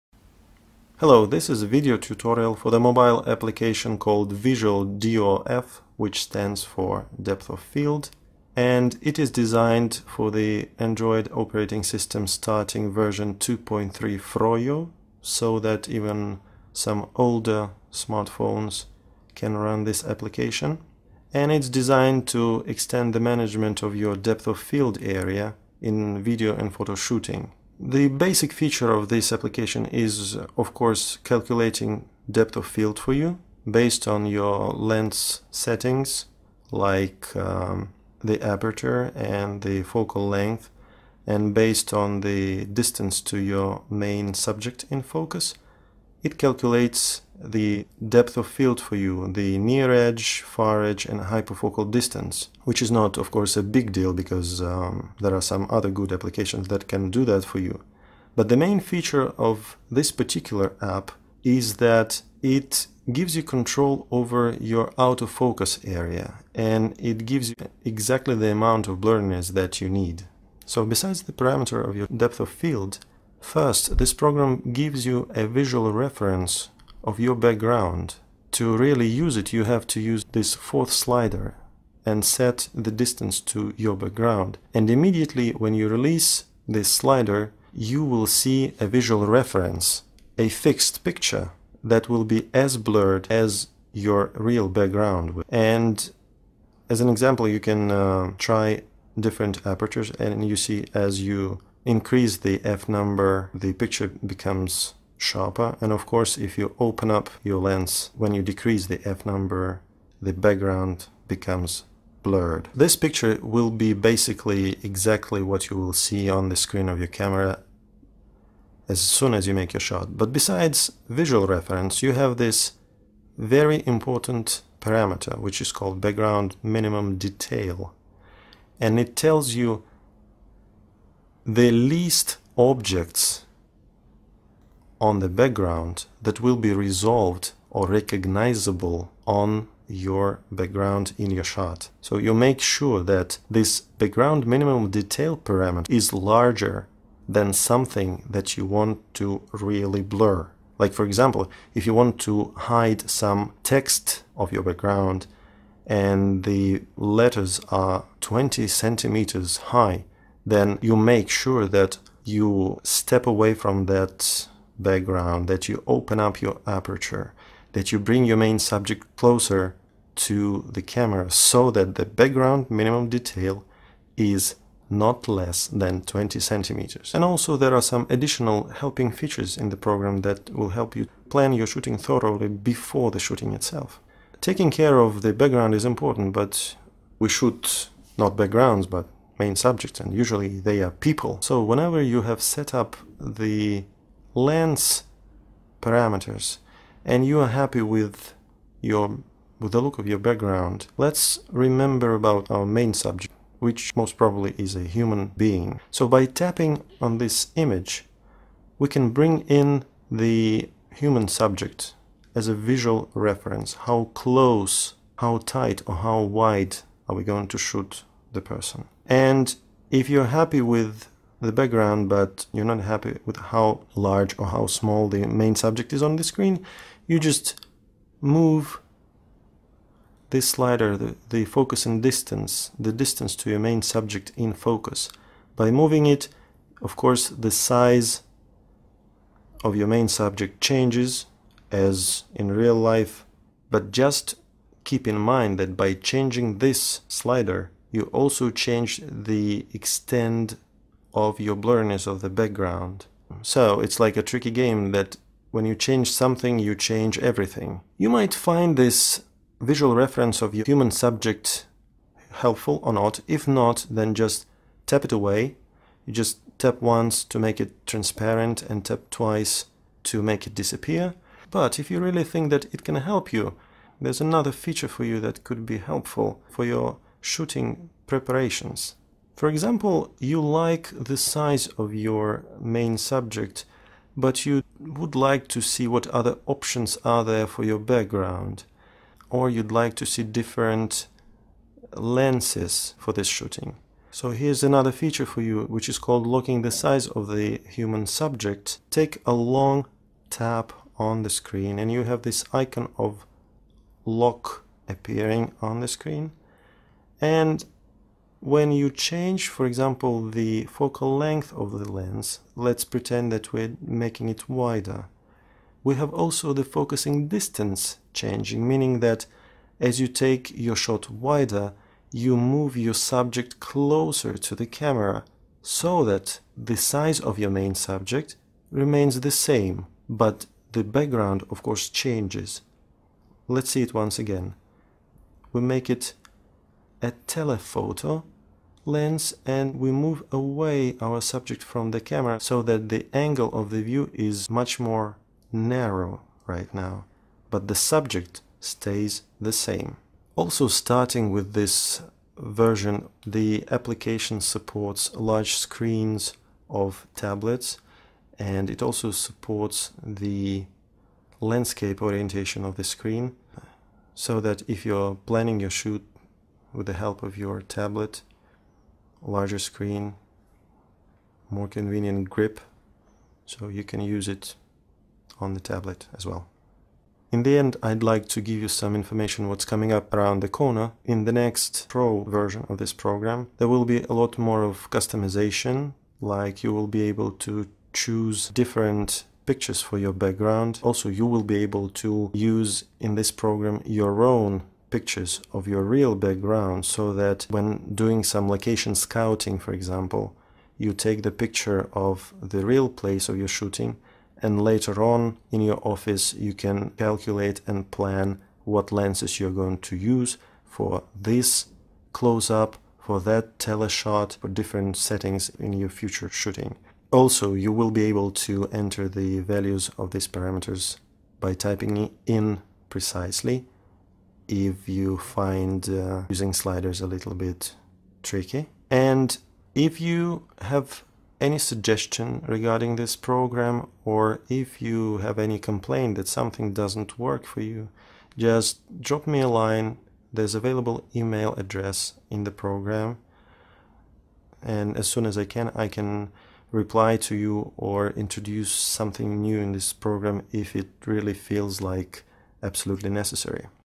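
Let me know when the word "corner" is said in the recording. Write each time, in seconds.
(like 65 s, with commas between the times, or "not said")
380 s.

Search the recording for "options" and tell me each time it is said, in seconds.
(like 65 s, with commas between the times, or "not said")
286 s.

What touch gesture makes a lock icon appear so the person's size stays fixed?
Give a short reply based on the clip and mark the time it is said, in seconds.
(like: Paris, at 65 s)
long tap, at 299 s.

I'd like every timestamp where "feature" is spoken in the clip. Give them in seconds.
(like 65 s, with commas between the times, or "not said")
28 s, 58 s, 179 s, 274 s, 294 s.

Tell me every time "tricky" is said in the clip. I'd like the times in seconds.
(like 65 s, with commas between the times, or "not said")
254 s, 428 s.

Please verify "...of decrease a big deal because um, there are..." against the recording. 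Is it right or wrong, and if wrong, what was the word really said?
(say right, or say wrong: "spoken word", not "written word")
wrong: "course", not "decrease".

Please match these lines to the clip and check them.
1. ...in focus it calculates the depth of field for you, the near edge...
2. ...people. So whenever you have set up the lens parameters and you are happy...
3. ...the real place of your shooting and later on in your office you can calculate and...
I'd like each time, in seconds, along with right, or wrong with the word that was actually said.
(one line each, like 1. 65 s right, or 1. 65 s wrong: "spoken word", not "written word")
1. 44 s right
2. 190 s right
3. 402 s right.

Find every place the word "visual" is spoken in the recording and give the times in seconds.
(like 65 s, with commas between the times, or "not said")
4 s, 75 s, 88 s, 121 s, 212 s, 259 s.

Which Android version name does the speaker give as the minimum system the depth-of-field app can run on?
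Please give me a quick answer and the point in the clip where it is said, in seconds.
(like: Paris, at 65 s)
2.3 Froyo, at 13 s.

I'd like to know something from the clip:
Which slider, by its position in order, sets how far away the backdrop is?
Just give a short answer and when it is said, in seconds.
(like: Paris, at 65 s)
fourth, at 80 s.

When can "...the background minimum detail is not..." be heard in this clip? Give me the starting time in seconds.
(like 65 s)
171 s.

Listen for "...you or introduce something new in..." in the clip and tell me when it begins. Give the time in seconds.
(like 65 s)
447 s.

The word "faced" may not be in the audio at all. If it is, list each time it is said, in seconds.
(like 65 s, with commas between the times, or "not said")
not said.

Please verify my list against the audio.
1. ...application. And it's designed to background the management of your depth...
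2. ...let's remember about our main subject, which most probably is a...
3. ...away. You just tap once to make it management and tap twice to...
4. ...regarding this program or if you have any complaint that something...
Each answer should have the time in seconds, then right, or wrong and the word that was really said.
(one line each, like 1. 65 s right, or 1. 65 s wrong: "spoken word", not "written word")
1. 20 s wrong: "extend", not "background"
2. 200 s right
3. 265 s wrong: "transparent", not "management"
4. 432 s right.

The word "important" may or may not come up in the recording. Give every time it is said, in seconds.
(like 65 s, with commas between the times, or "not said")
123 s, 185 s.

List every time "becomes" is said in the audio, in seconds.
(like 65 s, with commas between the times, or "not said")
104 s, 111 s.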